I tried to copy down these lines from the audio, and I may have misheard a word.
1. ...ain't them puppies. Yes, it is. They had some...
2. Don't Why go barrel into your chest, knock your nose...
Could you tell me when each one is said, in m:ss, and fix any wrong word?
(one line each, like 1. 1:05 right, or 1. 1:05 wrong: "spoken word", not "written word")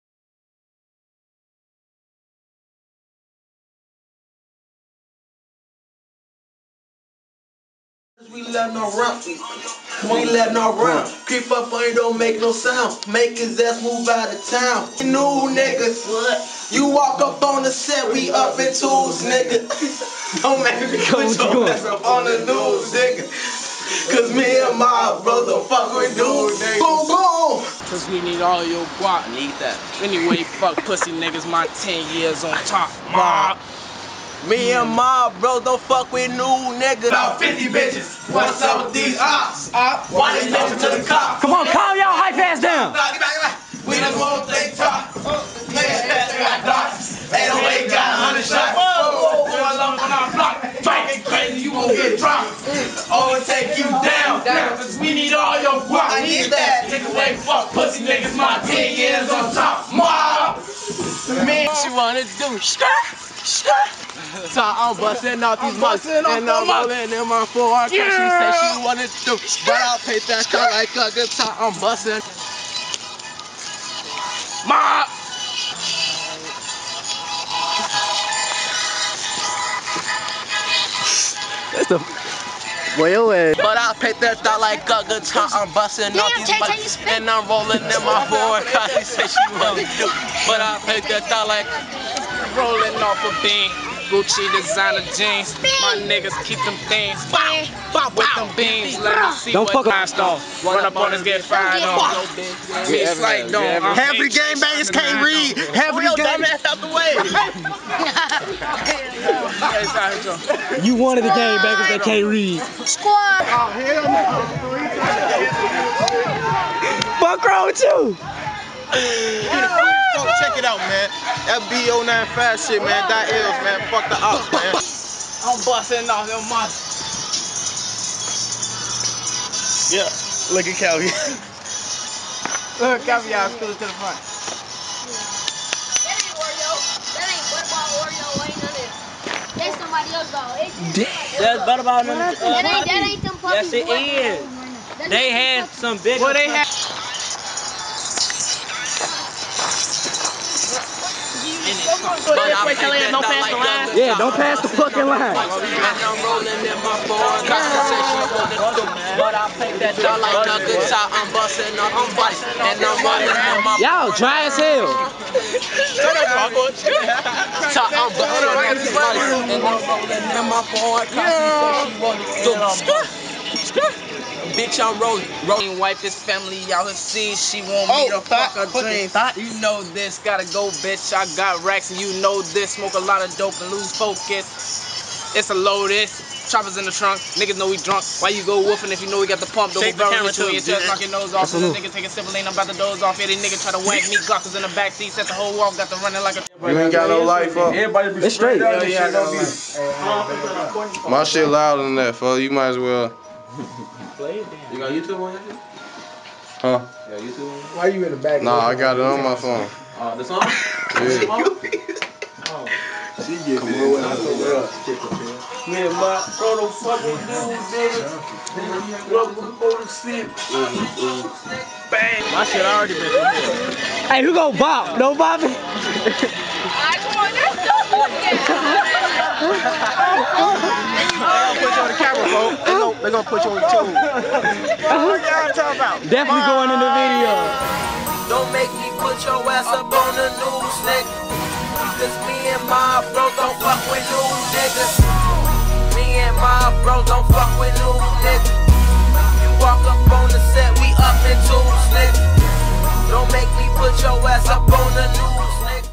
1. 2:23 right
2. 3:09 wrong: "Shake", not "Why".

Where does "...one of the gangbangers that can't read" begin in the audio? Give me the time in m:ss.
1:50.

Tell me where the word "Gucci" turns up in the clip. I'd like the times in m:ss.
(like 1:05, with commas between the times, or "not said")
1:34.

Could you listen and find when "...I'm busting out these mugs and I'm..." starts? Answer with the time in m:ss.
1:04.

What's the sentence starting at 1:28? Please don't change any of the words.
Cause She said she wanted to, but I picked that thought like rolling off a bean.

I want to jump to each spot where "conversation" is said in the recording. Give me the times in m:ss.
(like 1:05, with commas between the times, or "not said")
2:37, 2:51.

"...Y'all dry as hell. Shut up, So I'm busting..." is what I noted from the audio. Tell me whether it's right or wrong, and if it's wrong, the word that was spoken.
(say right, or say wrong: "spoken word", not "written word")
right.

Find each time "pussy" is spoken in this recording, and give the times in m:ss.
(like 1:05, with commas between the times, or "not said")
0:30, 0:57.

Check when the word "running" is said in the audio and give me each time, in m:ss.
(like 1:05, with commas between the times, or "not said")
2:43, 3:16.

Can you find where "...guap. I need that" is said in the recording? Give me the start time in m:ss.
0:55.